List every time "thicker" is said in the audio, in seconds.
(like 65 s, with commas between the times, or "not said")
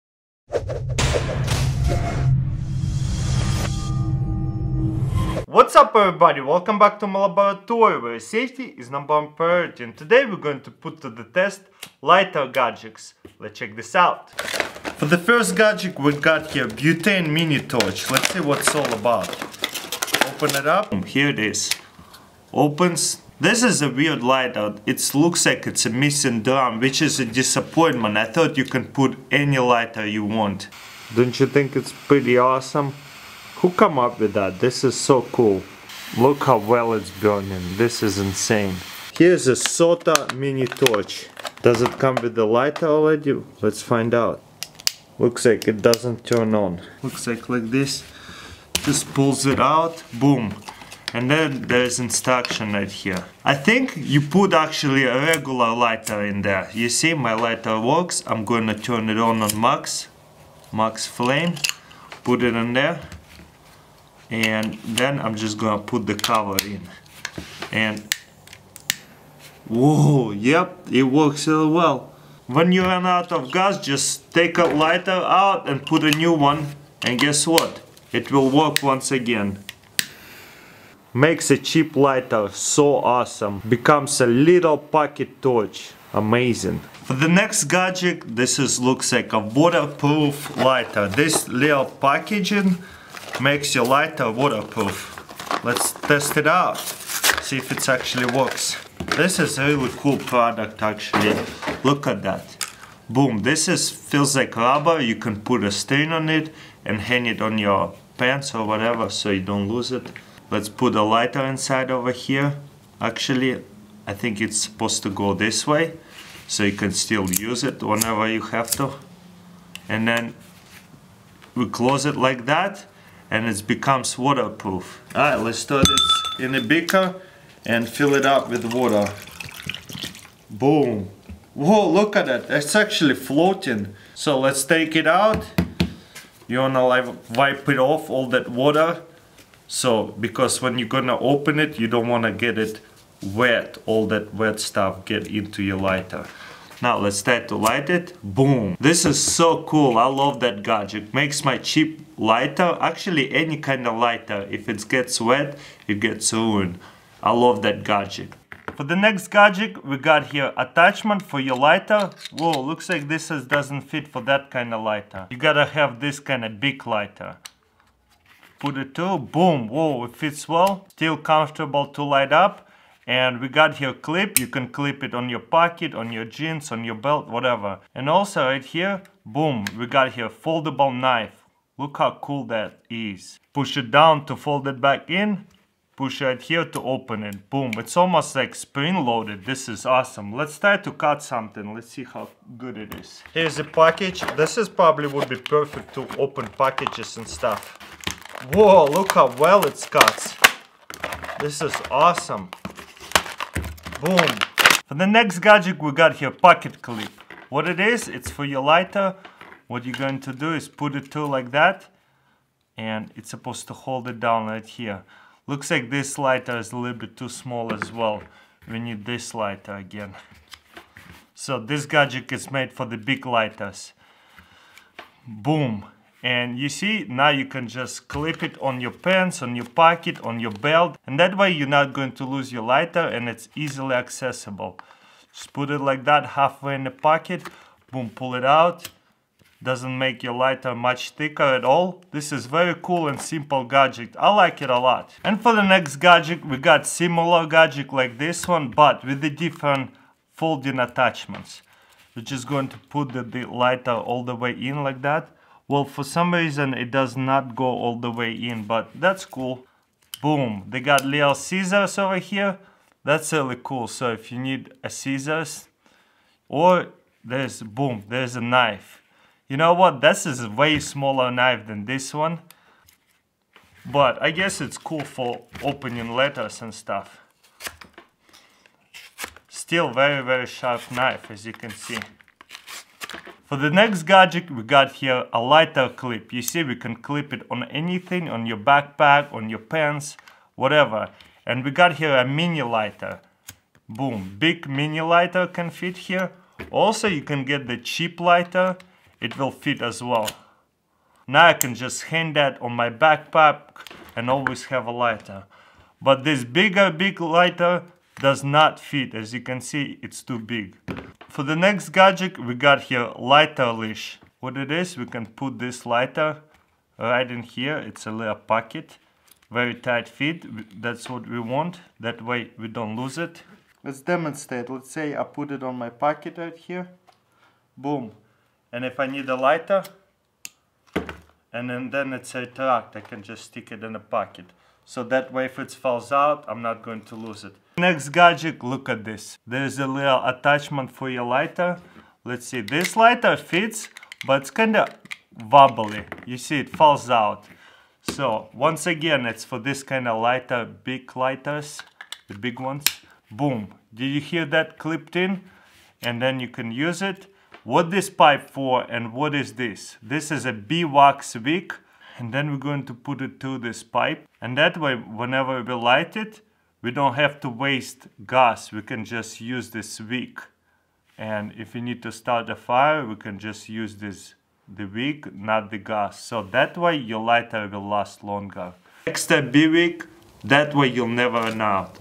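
241 s.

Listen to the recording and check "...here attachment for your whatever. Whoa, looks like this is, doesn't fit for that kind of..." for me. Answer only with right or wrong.
wrong.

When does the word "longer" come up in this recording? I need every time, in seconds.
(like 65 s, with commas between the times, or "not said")
378 s.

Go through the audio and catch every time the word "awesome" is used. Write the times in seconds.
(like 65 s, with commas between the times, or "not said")
32 s, 82 s, 189 s, 201 s.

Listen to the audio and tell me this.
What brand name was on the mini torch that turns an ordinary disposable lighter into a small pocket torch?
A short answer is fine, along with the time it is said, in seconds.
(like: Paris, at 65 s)
SOTO, at 39 s.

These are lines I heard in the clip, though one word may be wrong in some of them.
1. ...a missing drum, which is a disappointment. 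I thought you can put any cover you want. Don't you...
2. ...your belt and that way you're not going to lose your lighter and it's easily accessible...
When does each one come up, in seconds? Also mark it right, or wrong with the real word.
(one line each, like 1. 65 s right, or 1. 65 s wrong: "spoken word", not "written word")
1. 25 s wrong: "lighter", not "cover"
2. 230 s right.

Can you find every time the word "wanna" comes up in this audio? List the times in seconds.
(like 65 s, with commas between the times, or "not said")
136 s, 142 s.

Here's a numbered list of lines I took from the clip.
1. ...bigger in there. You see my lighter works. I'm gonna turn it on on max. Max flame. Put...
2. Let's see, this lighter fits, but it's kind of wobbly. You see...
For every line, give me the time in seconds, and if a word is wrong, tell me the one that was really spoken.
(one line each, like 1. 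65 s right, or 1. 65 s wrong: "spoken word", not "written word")
1. 55 s wrong: "lighter", not "bigger"
2. 342 s right.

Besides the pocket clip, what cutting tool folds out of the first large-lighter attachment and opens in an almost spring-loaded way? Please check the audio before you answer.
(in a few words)
foldable knife.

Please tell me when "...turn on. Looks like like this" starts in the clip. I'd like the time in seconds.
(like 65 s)
46 s.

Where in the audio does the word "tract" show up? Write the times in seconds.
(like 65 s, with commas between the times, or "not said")
332 s.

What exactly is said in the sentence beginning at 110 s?
Let's put a lighter inside over here.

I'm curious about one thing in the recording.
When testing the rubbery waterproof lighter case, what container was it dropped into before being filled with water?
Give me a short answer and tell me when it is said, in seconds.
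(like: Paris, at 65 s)
a beaker, at 126 s.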